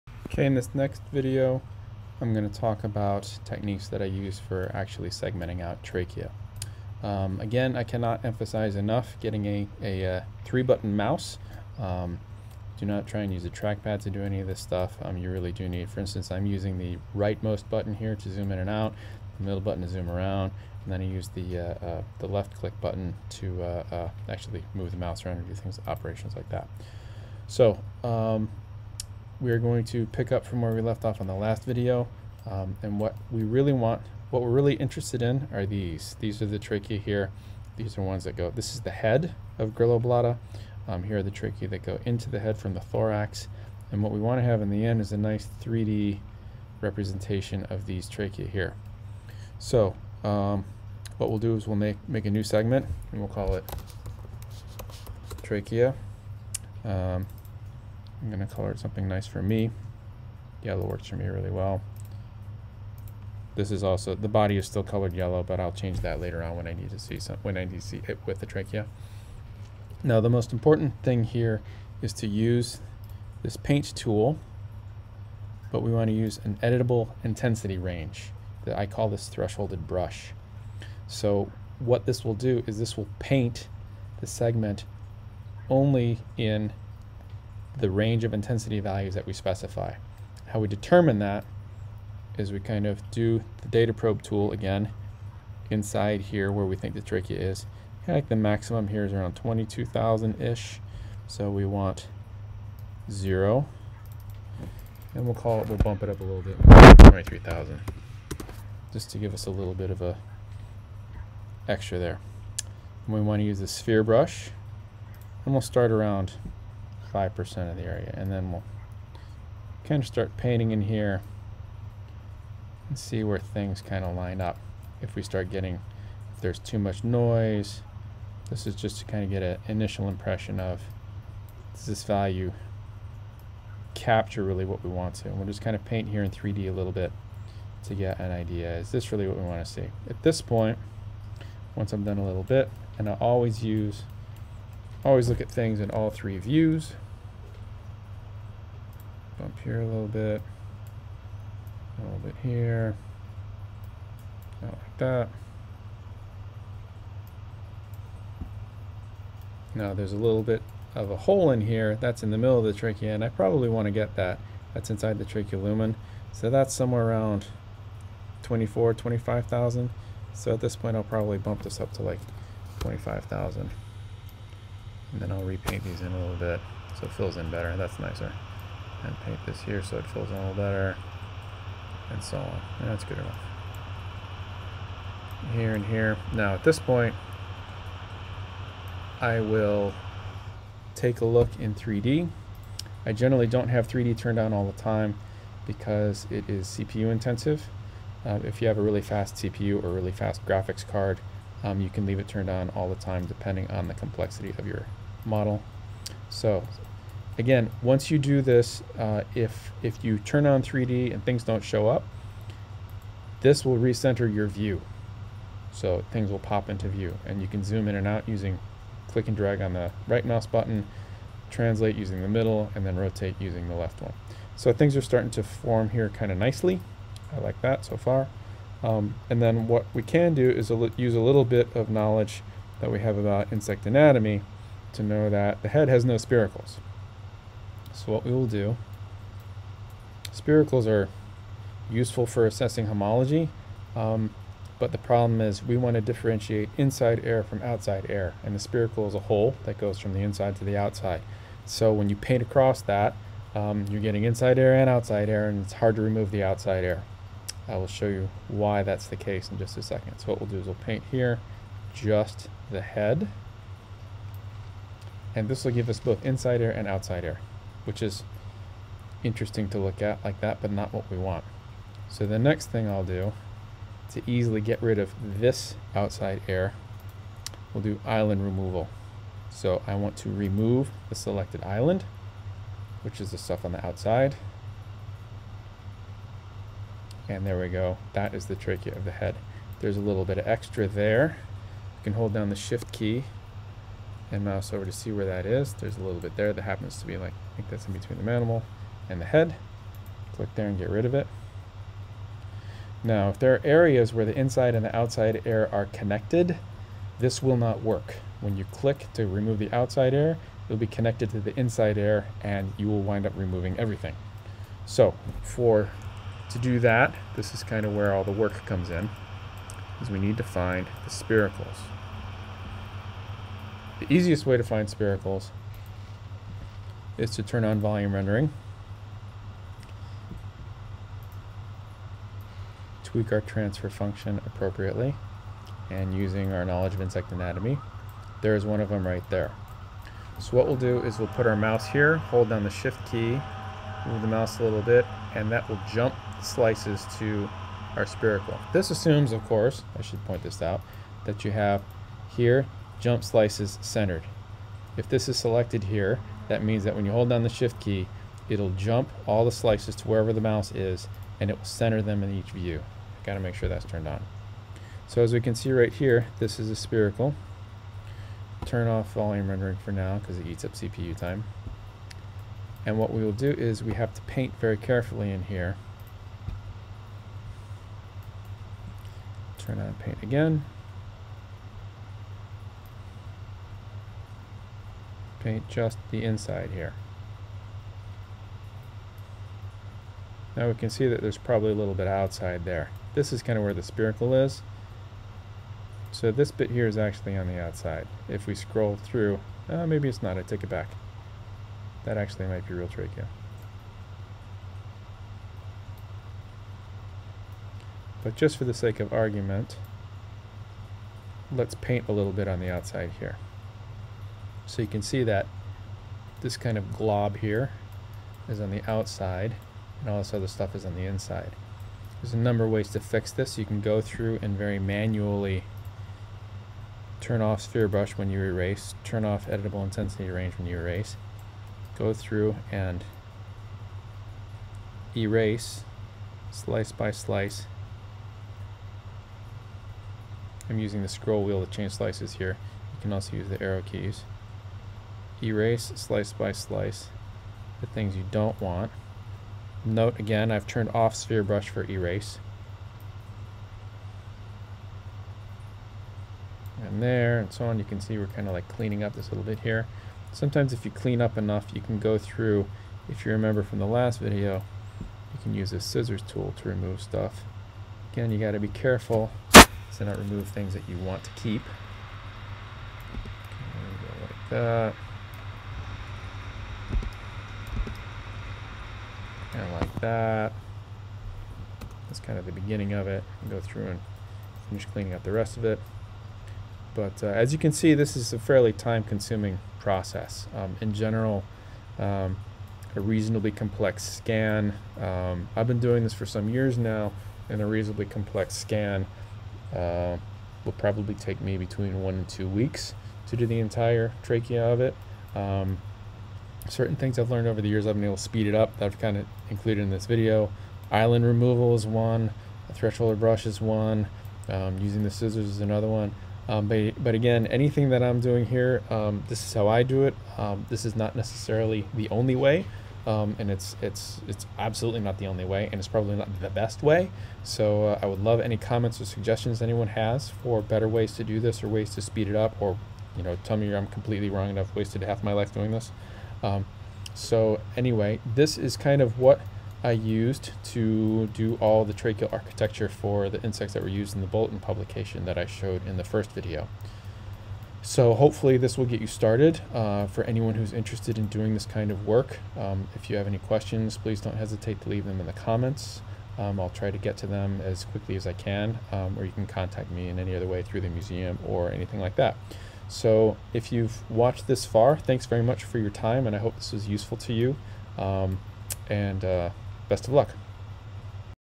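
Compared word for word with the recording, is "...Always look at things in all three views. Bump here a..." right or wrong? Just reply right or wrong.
right.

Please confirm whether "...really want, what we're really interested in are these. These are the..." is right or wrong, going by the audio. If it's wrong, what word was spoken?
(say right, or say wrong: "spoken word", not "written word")
right.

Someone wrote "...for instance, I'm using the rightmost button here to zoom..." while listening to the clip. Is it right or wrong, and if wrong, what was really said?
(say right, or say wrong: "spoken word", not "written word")
right.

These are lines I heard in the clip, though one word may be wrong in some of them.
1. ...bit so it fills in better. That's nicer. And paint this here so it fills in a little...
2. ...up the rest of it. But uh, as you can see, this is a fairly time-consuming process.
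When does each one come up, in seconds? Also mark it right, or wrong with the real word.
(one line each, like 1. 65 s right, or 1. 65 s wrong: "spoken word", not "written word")
1. 176 s right
2. 485 s right.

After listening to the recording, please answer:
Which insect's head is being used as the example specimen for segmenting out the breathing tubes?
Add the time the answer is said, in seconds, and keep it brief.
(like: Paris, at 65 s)
Grilloblatta, at 39 s.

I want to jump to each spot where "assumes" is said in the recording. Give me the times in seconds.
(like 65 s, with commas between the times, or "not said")
348 s.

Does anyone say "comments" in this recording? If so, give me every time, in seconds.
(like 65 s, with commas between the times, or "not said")
528 s, 555 s.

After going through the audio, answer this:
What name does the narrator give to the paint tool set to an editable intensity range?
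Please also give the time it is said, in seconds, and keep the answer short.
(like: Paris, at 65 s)
thresholded brush, at 79 s.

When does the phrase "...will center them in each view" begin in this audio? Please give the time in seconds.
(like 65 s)
361 s.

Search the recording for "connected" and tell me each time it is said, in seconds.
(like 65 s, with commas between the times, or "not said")
305 s, 310 s.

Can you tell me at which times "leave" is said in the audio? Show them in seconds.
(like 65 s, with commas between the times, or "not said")
202 s, 554 s.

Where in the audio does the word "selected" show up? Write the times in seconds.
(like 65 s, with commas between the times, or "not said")
281 s, 355 s.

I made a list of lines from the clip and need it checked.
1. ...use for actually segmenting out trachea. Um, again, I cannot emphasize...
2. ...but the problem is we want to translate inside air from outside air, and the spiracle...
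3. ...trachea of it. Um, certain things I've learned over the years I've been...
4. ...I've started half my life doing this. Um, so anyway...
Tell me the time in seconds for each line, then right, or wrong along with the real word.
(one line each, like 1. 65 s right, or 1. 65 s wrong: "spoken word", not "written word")
1. 4 s right
2. 244 s wrong: "differentiate", not "translate"
3. 504 s right
4. 534 s wrong: "wasted", not "started".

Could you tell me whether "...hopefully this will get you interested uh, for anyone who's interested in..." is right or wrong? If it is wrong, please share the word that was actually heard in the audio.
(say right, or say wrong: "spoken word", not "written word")
wrong: "started", not "interested".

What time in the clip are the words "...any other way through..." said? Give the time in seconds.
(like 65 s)
560 s.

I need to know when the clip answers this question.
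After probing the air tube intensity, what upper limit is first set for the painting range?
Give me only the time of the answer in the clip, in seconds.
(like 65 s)
107 s.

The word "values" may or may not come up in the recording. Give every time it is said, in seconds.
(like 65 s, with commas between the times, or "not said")
88 s, 132 s.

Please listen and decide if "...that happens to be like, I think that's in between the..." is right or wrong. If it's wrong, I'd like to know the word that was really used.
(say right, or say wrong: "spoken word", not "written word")
right.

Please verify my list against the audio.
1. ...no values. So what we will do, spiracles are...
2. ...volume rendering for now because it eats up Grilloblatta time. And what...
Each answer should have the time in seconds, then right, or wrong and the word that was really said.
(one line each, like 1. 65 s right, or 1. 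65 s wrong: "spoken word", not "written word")
1. 236 s wrong: "spiracles", not "values"
2. 369 s wrong: "CPU", not "Grilloblatta".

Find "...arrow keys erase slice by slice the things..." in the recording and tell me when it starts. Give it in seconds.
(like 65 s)
443 s.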